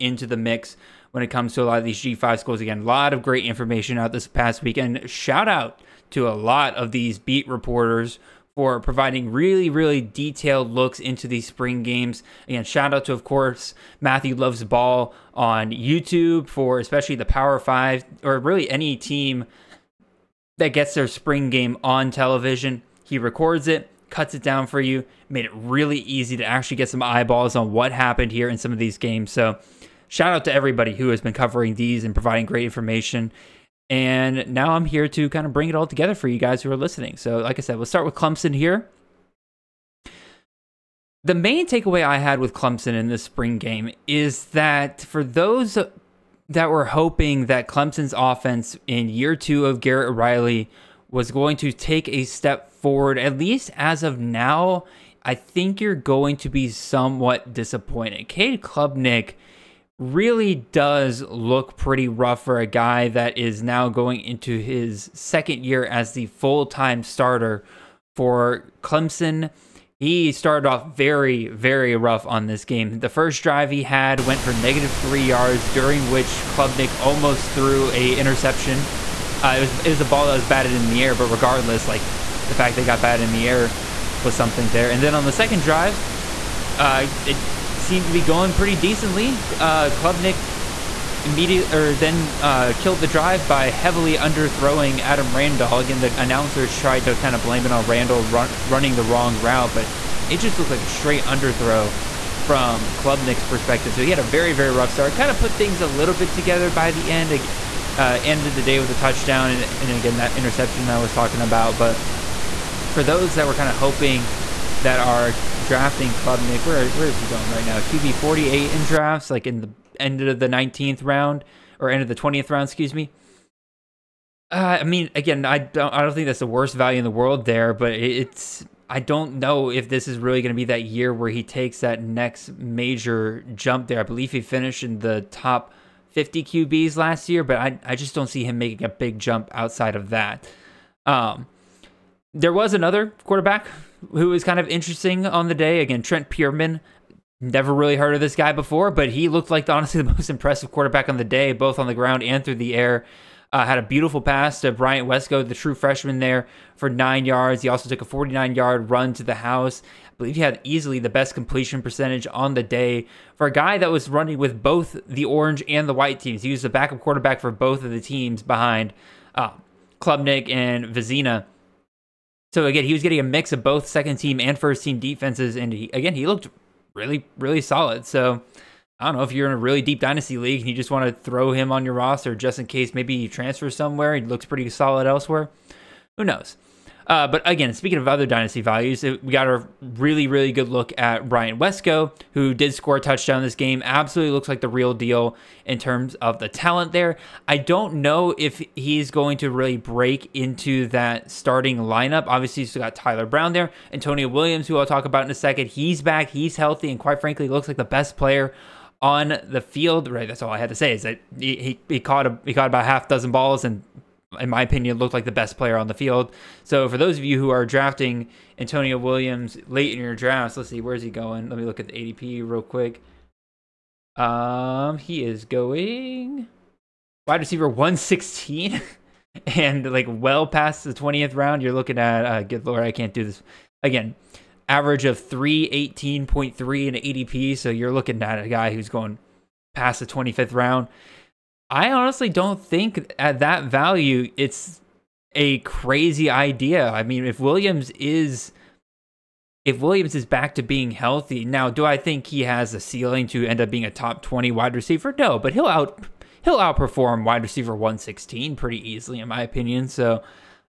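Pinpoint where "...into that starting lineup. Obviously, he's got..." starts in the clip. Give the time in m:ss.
3:20.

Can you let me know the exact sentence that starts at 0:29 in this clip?
So, shout out to everybody who has been covering these and providing great information.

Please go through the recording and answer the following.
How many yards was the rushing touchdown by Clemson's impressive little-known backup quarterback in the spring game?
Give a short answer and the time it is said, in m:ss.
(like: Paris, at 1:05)
49, at 2:38.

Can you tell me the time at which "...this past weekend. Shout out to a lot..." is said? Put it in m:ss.
0:04.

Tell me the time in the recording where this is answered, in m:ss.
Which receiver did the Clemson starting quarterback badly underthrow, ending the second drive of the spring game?
1:35.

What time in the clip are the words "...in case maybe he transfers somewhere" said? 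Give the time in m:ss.
3:02.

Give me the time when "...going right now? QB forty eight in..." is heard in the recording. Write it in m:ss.
1:57.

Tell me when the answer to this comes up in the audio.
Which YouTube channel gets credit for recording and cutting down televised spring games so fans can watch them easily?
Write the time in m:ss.
0:14.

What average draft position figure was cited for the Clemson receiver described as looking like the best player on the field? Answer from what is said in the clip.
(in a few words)
318.3.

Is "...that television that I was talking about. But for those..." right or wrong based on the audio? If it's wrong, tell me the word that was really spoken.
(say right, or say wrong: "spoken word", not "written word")
wrong: "interception", not "television".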